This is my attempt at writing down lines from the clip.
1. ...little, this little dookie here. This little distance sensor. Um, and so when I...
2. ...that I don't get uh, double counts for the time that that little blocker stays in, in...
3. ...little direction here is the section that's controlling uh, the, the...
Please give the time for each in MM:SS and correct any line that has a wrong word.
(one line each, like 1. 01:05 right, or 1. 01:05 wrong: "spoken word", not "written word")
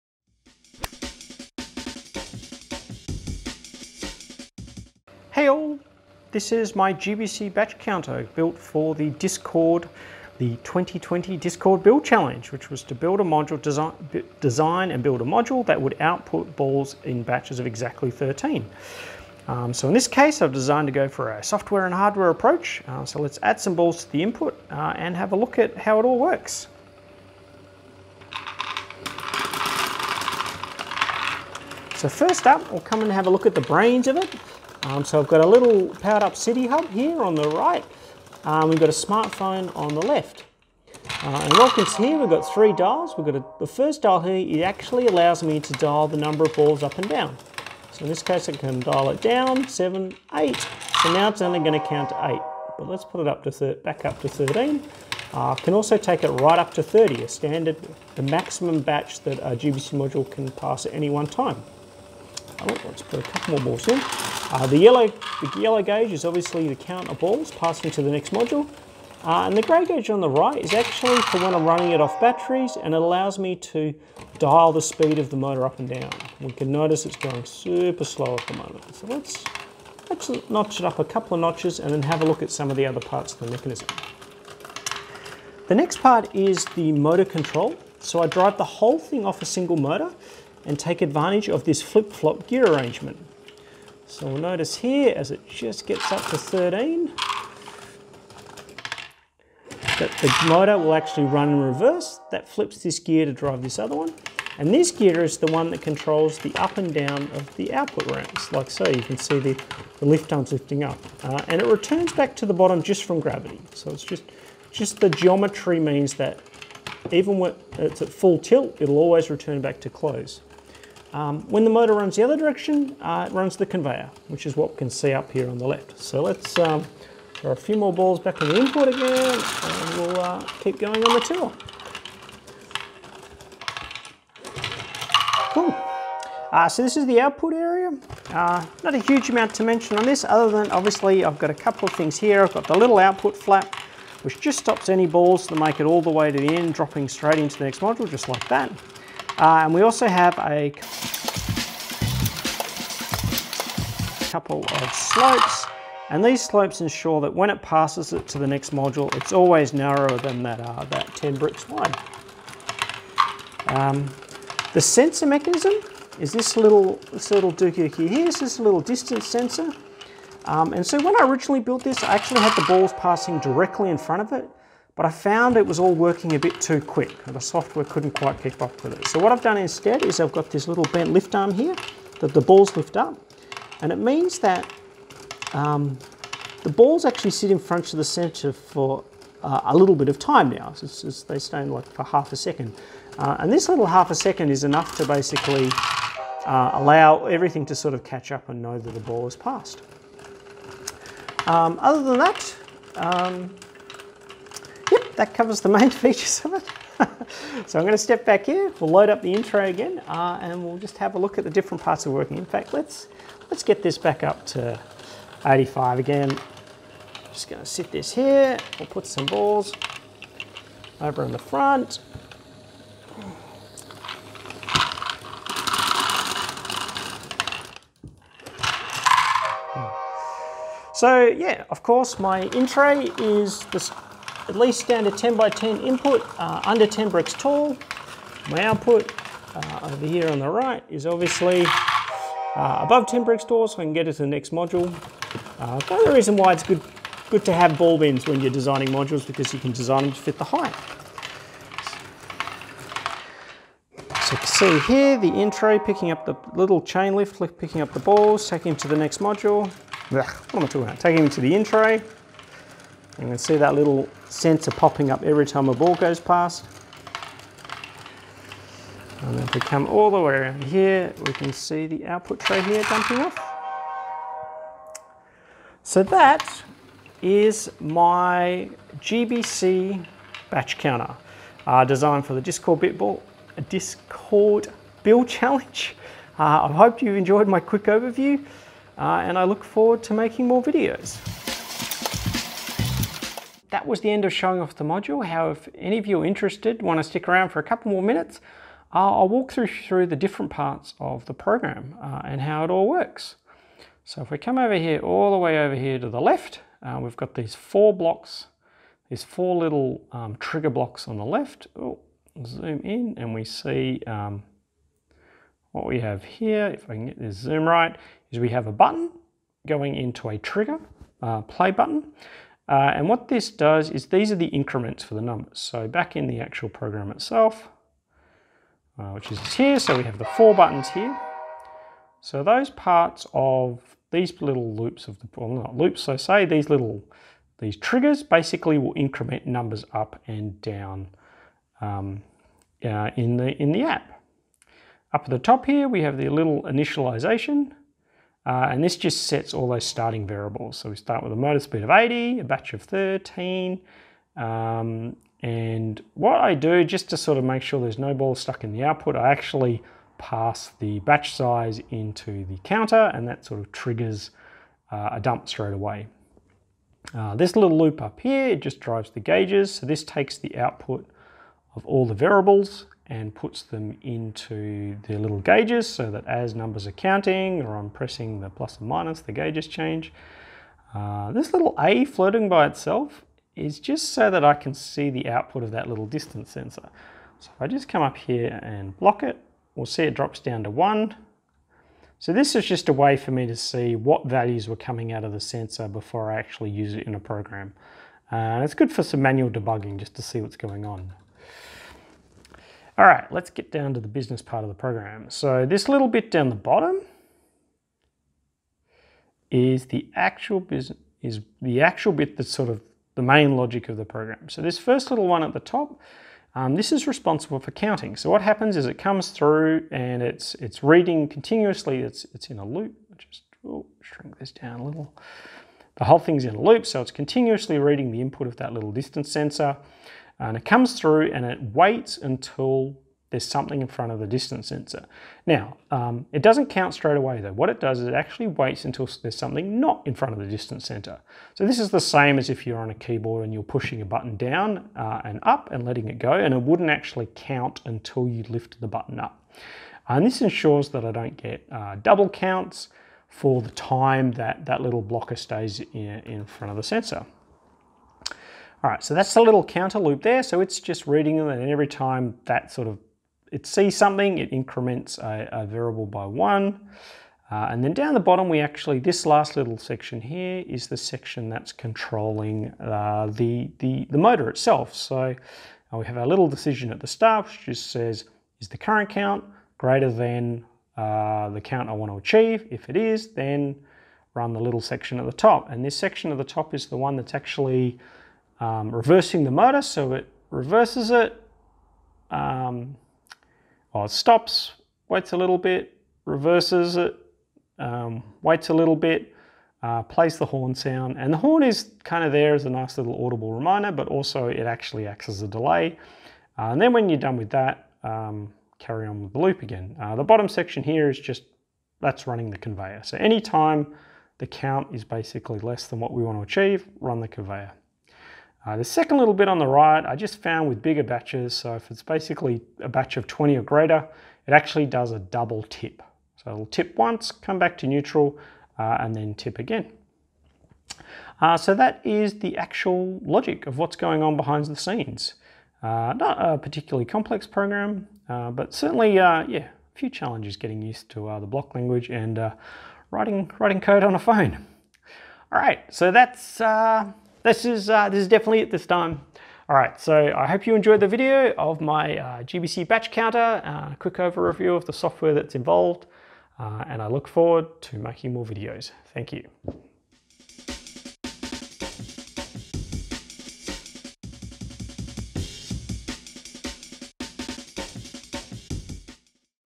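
1. 02:46 right
2. 07:30 right
3. 07:49 wrong: "section", not "direction".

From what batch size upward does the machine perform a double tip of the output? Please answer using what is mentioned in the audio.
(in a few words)
20.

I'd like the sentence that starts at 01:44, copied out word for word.
And this gear is the one that controls the up and down of the output ramps, like so.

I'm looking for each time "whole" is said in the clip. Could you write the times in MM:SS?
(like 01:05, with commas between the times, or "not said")
01:28, 07:06.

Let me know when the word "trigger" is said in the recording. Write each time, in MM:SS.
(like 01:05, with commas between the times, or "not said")
05:10, 05:20, 05:37, 06:03.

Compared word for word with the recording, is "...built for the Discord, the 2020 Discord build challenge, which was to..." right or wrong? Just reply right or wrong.
right.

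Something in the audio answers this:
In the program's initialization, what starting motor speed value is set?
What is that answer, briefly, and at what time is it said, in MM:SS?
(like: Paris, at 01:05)
80, at 05:51.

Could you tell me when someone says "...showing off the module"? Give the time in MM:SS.
04:54.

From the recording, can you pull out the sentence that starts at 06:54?
So this first little one at the top, um, this is responsible for counting.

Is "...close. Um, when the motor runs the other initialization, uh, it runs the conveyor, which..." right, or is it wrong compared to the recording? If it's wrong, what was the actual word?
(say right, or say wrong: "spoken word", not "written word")
wrong: "direction", not "initialization".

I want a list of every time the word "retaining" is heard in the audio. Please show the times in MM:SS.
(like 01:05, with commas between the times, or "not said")
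not said.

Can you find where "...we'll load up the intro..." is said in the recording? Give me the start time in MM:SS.
03:28.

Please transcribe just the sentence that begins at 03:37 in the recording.
Just going to sit this here, we'll put some balls over in the front.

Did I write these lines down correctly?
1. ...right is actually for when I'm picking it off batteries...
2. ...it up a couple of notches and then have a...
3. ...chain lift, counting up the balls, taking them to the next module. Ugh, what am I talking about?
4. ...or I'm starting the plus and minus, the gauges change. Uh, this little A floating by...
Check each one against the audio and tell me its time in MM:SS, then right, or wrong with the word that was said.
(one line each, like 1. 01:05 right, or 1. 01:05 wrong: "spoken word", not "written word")
1. 01:10 wrong: "running", not "picking"
2. 01:20 right
3. 04:16 wrong: "picking", not "counting"
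4. 06:17 wrong: "pressing", not "starting".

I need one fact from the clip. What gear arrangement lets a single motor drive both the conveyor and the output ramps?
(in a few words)
flip-flop gear.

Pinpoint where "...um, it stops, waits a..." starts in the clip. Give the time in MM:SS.
08:12.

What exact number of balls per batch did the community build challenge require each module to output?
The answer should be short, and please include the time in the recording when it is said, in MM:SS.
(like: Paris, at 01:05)
13, at 00:17.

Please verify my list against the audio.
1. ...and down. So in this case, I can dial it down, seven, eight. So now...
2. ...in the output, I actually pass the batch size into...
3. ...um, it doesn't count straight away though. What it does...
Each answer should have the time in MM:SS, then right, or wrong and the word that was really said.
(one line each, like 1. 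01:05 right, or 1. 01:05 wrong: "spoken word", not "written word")
1. 00:46 right
2. 05:58 right
3. 07:15 right.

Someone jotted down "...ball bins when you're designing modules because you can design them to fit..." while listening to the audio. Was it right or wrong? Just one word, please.
right.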